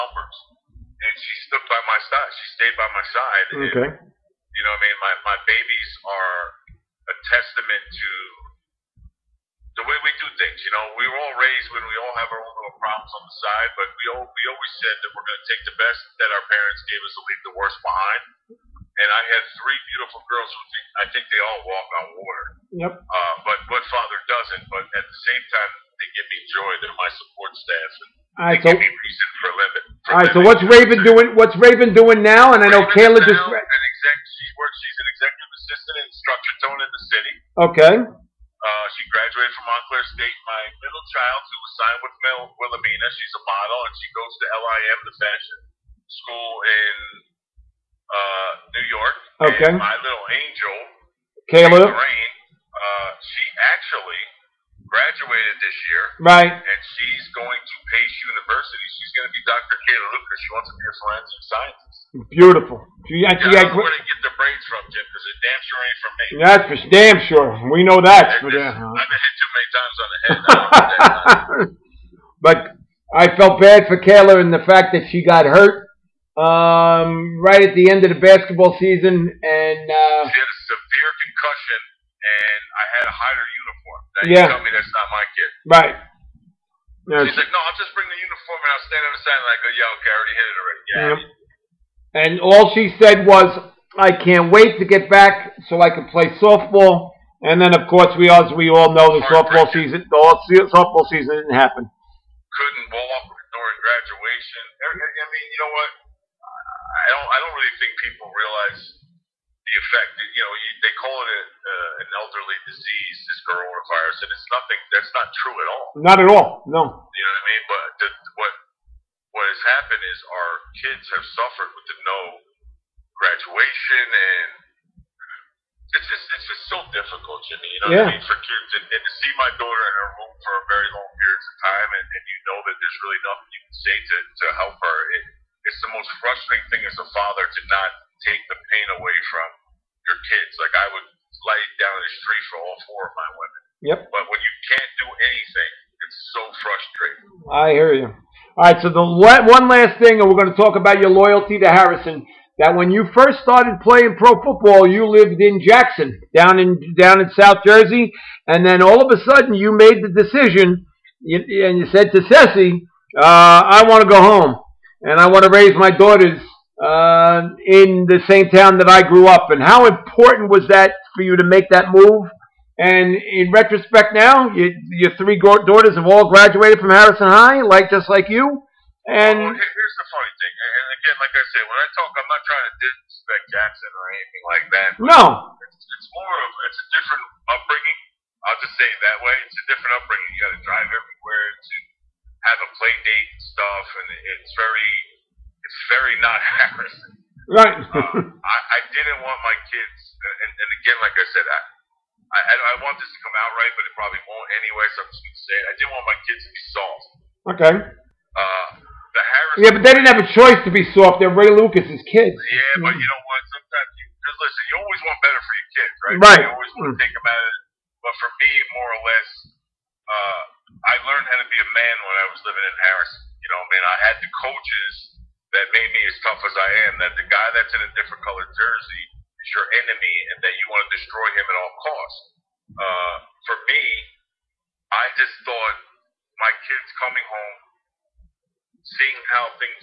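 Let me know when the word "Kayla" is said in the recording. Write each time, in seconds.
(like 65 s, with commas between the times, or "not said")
32 s, 51 s, 59 s, 74 s.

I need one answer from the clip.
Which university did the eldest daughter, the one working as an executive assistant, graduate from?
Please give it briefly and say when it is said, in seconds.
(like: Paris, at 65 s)
Montclair State, at 39 s.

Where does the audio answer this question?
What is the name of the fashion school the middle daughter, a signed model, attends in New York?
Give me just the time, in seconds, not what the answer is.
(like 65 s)
44 s.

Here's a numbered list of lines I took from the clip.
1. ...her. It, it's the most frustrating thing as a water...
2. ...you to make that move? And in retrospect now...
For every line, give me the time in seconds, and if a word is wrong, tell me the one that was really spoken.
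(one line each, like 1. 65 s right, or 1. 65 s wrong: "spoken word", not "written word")
1. 134 s wrong: "father", not "water"
2. 171 s right.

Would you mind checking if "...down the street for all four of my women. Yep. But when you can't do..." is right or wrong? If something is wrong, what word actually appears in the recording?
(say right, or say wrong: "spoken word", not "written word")
right.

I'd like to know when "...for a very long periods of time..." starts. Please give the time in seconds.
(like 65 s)
130 s.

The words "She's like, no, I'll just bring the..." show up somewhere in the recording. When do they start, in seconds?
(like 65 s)
87 s.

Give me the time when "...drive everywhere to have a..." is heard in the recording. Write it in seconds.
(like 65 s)
190 s.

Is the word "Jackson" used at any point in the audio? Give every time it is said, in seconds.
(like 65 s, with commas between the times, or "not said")
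155 s, 183 s.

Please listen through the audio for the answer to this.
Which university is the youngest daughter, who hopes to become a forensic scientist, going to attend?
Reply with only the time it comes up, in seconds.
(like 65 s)
57 s.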